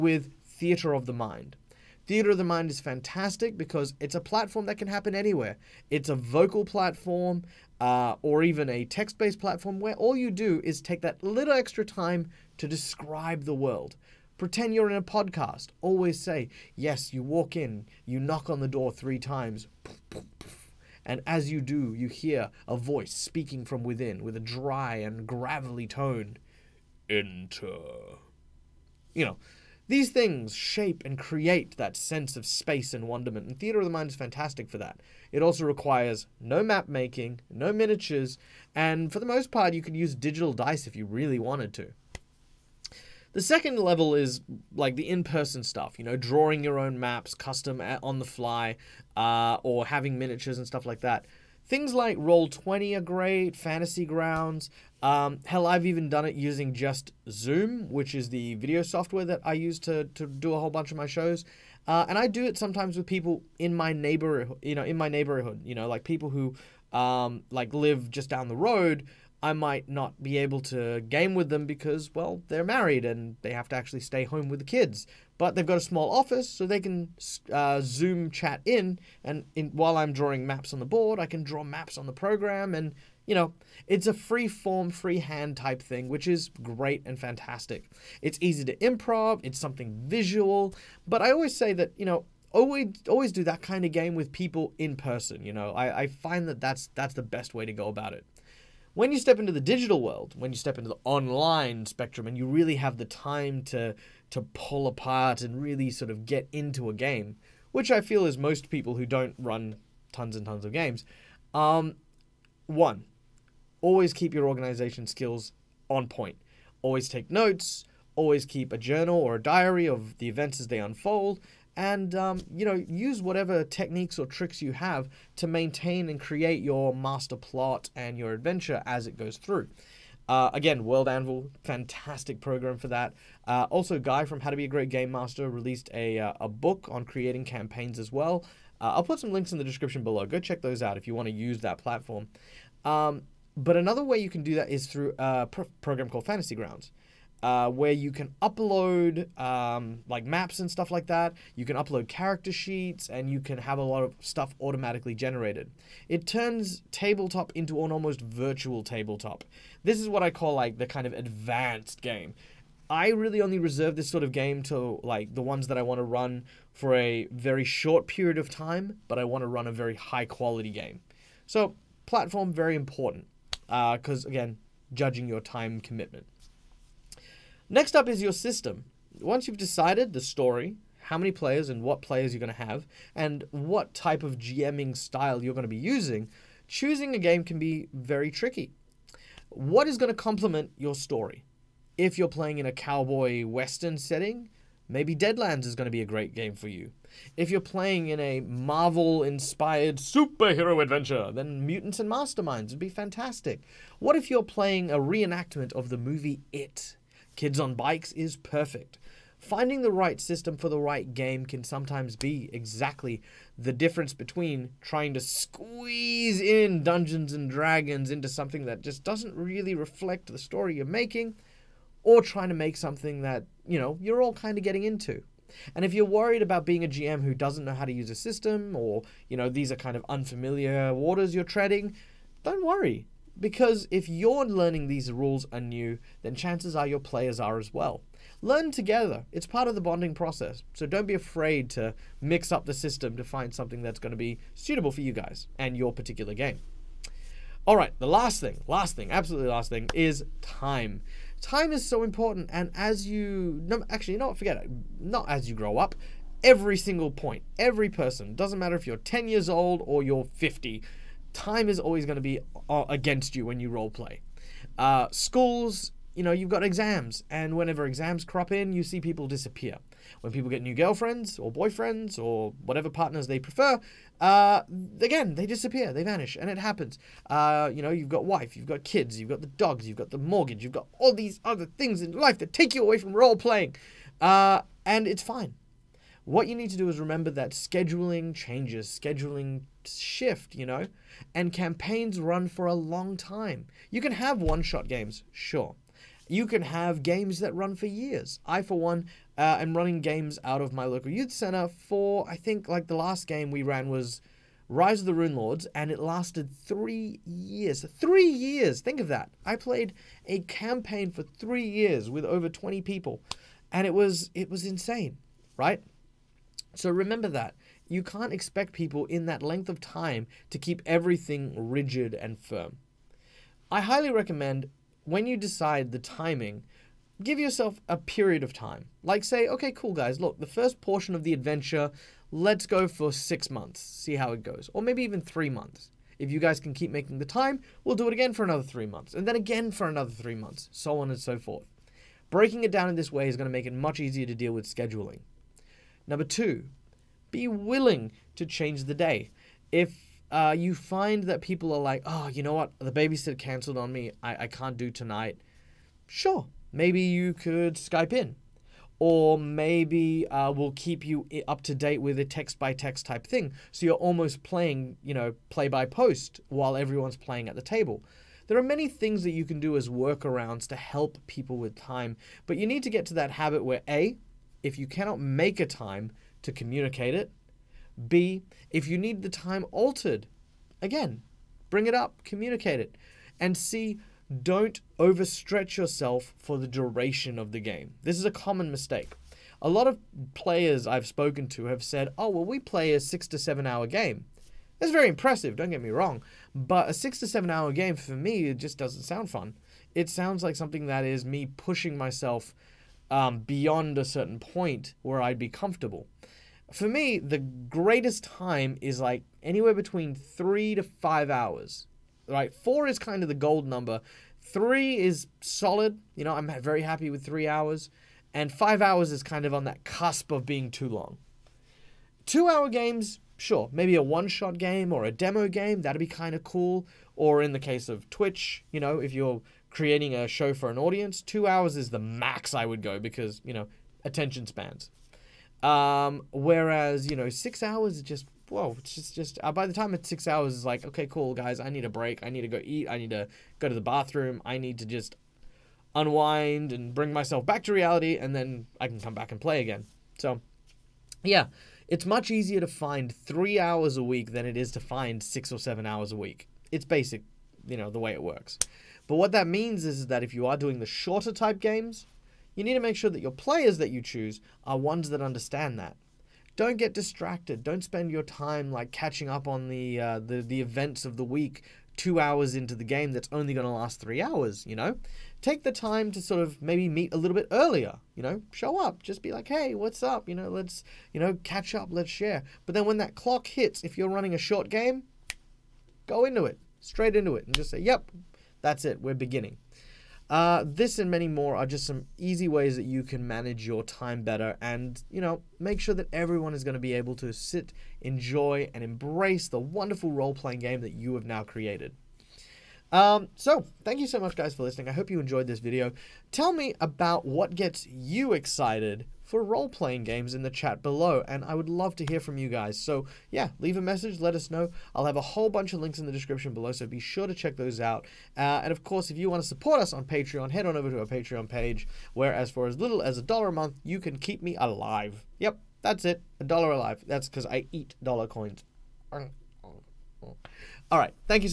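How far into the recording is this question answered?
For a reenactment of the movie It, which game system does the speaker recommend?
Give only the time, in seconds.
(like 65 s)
207 s.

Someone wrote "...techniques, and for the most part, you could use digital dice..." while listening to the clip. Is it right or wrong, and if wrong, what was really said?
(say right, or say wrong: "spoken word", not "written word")
wrong: "miniatures", not "techniques".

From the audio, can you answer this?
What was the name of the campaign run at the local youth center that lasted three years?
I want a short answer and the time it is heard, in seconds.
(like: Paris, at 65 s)
Rise of the Runelords, at 304 s.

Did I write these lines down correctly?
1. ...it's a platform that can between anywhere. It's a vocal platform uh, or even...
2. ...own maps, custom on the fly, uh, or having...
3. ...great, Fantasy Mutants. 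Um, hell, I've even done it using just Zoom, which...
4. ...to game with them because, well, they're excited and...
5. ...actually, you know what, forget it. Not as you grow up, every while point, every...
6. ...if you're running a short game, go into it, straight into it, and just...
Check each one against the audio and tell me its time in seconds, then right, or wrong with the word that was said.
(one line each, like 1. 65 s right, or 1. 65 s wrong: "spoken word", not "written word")
1. 3 s wrong: "happen", not "between"
2. 46 s right
3. 53 s wrong: "Grounds", not "Mutants"
4. 70 s wrong: "married", not "excited"
5. 253 s wrong: "single", not "while"
6. 483 s right.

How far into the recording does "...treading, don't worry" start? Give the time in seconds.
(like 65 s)
231 s.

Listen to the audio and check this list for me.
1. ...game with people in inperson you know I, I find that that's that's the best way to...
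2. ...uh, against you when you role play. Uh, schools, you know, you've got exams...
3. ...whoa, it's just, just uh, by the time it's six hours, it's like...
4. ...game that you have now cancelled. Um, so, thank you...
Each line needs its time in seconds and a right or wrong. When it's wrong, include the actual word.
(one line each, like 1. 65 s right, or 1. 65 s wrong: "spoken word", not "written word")
1. 93 s wrong: "person", not "inperson"
2. 262 s right
3. 438 s right
4. 500 s wrong: "created", not "cancelled".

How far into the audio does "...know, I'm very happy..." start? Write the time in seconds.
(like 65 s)
416 s.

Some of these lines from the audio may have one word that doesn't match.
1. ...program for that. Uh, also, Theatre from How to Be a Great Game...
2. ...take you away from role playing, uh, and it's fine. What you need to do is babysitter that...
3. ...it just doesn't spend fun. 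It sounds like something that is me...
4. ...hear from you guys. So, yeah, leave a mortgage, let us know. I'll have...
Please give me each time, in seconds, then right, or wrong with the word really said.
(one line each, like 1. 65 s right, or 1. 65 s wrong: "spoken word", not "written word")
1. 132 s wrong: "Guy", not "Theatre"
2. 282 s wrong: "remember", not "babysitter"
3. 398 s wrong: "sound", not "spend"
4. 512 s wrong: "message", not "mortgage".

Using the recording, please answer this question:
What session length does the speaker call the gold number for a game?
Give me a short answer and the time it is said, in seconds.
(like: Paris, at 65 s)
4 hours, at 412 s.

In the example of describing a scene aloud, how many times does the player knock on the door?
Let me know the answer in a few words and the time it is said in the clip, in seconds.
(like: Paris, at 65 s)
3, at 18 s.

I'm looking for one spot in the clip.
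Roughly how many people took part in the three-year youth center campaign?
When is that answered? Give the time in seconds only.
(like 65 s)
312 s.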